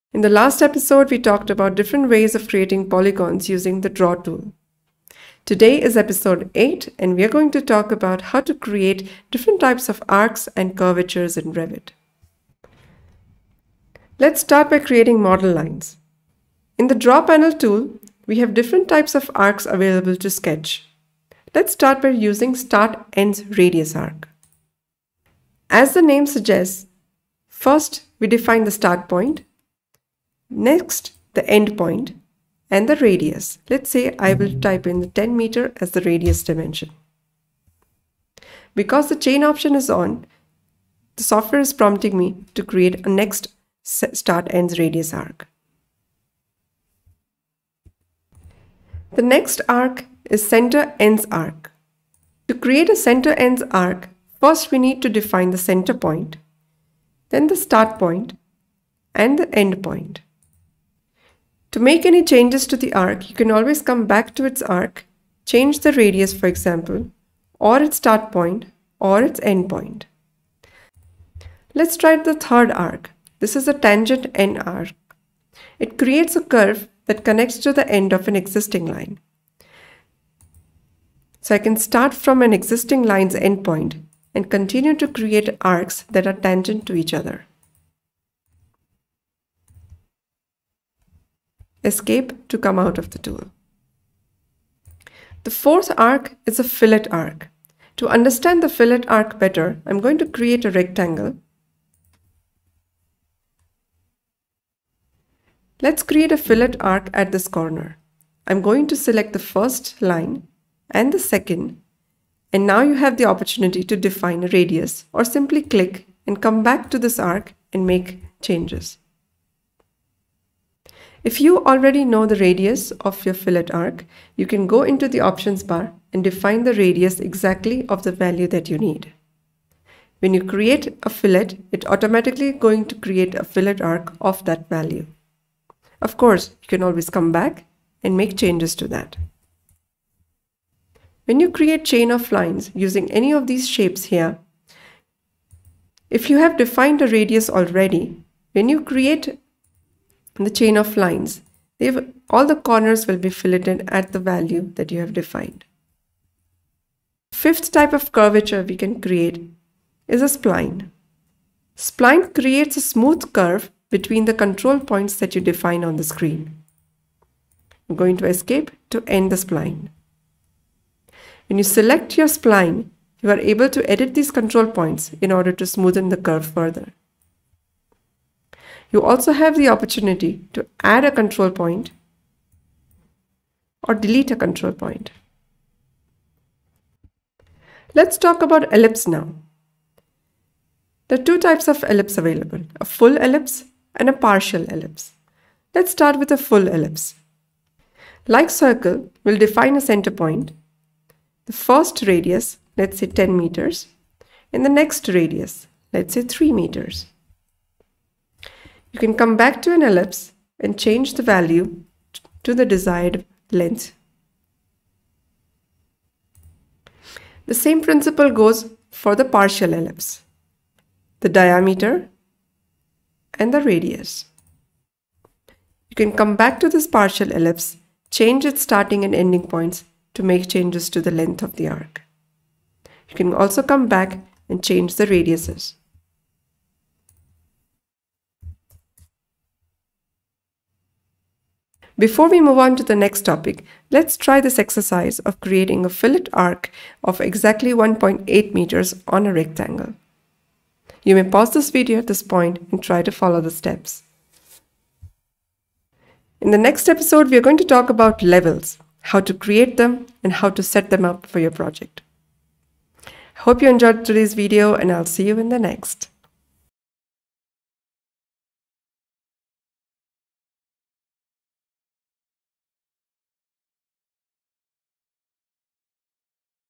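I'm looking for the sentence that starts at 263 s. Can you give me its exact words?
Hope you enjoyed today's video and I'll see you in the next.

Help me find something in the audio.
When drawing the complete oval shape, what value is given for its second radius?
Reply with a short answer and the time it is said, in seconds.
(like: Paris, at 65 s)
3 meters, at 206 s.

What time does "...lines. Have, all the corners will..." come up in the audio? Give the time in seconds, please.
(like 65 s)
150 s.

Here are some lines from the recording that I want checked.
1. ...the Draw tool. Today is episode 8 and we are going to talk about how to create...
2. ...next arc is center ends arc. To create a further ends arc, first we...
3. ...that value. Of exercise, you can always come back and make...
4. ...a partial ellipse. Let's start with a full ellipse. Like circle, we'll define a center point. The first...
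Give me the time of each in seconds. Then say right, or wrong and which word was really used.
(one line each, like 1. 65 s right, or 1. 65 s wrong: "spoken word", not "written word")
1. 3 s right
2. 49 s wrong: "center", not "further"
3. 134 s wrong: "course", not "exercise"
4. 194 s right.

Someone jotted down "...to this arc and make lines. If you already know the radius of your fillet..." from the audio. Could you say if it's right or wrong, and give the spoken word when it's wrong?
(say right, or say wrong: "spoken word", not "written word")
wrong: "changes", not "lines".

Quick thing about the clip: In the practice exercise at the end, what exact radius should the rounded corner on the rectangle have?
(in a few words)
1.8 meters.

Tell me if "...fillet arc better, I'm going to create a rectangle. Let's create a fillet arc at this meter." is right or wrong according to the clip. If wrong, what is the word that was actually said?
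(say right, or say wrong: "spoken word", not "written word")
wrong: "corner", not "meter".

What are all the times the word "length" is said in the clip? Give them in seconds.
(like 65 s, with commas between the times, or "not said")
213 s, 231 s.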